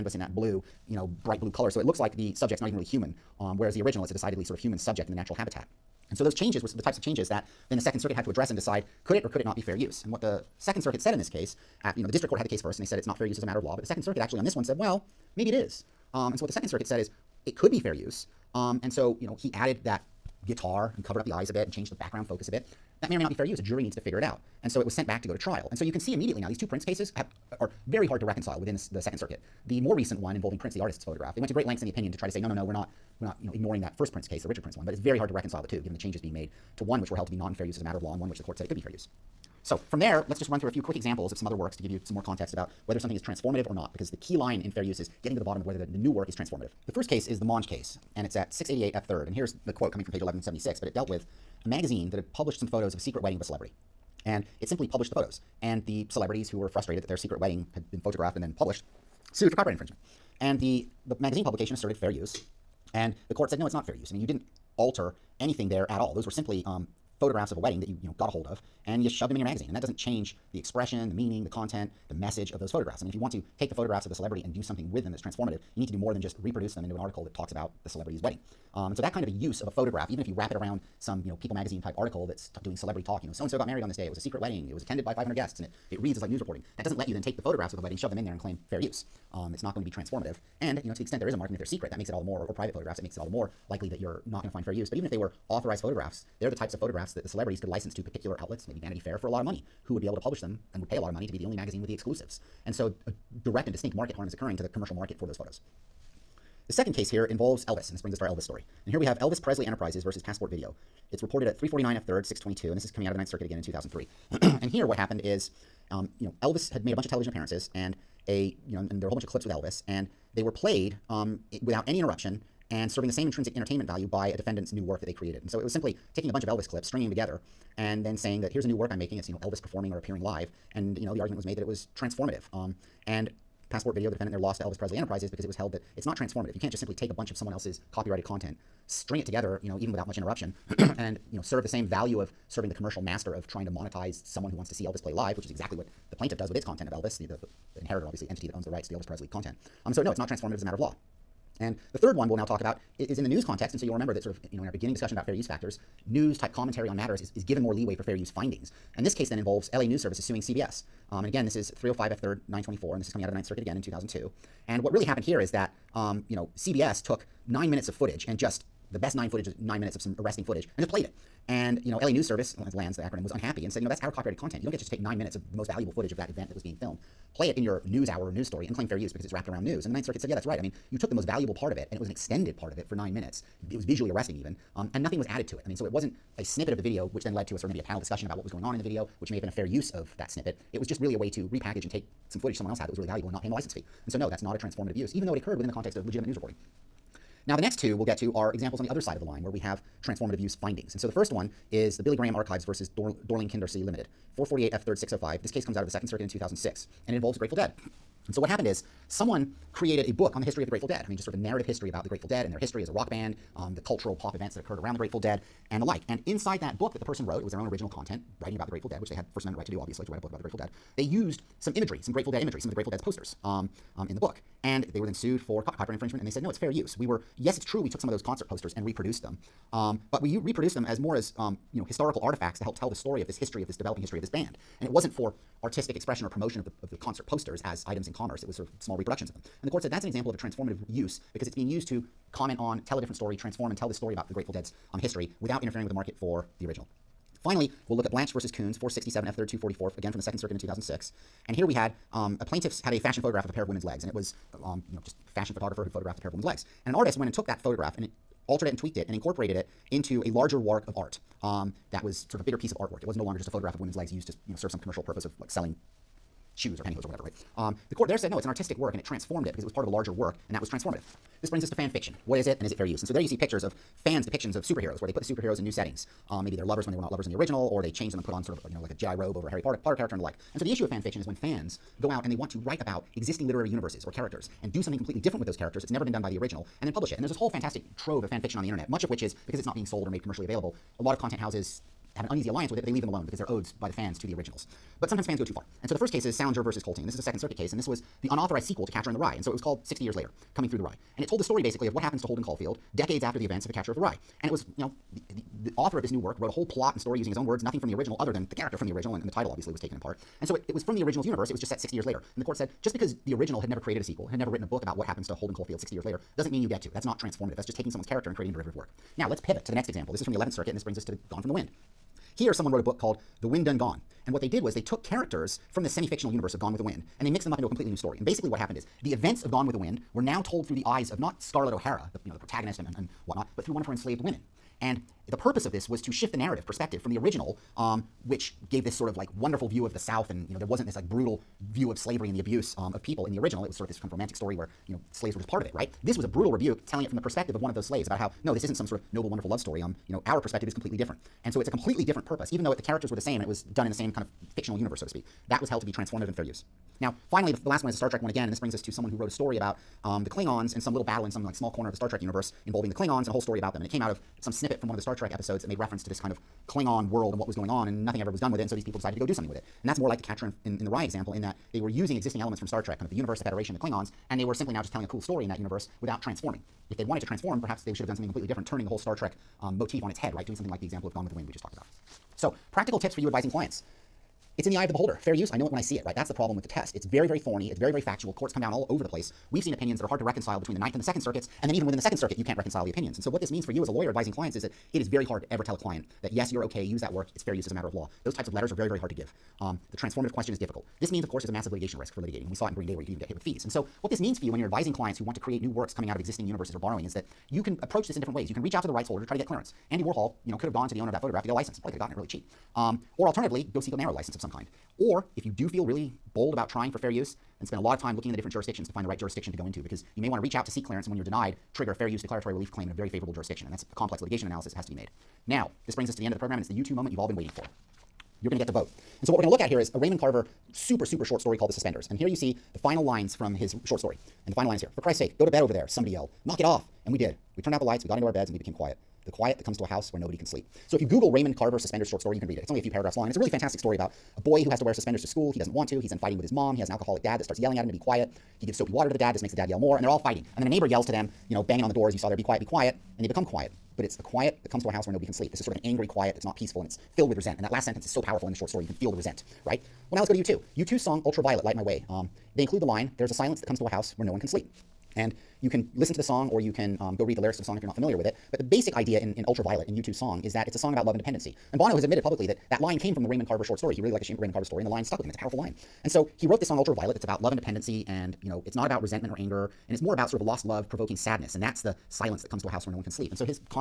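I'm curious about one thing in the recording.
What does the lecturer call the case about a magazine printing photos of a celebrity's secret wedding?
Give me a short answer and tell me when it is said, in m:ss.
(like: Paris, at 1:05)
Monge, at 0:47.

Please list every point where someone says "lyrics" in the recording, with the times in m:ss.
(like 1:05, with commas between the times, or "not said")
7:47.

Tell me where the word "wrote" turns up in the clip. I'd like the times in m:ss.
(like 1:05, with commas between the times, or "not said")
3:37, 5:06, 5:22, 5:59, 7:56.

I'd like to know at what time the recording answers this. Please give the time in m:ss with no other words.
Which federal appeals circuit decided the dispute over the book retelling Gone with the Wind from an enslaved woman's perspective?
5:20.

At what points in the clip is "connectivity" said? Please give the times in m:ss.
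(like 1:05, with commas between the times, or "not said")
not said.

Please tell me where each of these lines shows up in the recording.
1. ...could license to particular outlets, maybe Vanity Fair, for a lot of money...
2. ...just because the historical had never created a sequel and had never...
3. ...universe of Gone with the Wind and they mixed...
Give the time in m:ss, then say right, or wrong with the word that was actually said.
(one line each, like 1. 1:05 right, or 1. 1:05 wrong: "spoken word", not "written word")
1. 1:37 right
2. 5:12 wrong: "original", not "historical"
3. 5:26 right.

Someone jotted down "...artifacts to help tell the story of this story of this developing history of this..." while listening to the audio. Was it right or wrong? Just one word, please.
wrong.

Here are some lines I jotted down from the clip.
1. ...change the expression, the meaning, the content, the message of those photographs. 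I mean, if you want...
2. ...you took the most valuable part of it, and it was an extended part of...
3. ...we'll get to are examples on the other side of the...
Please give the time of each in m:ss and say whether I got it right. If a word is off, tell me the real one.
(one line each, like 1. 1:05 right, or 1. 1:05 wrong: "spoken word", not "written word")
1. 1:09 right
2. 3:00 right
3. 3:17 right.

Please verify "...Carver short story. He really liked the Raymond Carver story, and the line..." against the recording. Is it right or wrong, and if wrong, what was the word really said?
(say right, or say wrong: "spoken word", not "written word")
right.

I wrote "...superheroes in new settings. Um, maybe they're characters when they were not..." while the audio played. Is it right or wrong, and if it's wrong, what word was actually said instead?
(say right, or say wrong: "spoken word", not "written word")
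wrong: "lovers", not "characters".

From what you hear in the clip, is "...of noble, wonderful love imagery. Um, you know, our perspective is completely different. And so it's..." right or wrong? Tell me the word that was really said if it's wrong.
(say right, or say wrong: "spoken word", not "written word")
wrong: "story", not "imagery".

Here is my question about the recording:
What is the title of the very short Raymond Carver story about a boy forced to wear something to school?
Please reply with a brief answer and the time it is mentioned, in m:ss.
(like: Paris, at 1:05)
The Suspenders, at 7:11.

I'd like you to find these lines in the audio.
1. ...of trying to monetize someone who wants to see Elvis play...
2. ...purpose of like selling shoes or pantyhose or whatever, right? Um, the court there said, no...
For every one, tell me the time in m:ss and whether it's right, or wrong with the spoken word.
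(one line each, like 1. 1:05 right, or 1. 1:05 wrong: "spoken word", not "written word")
1. 2:23 right
2. 4:25 right.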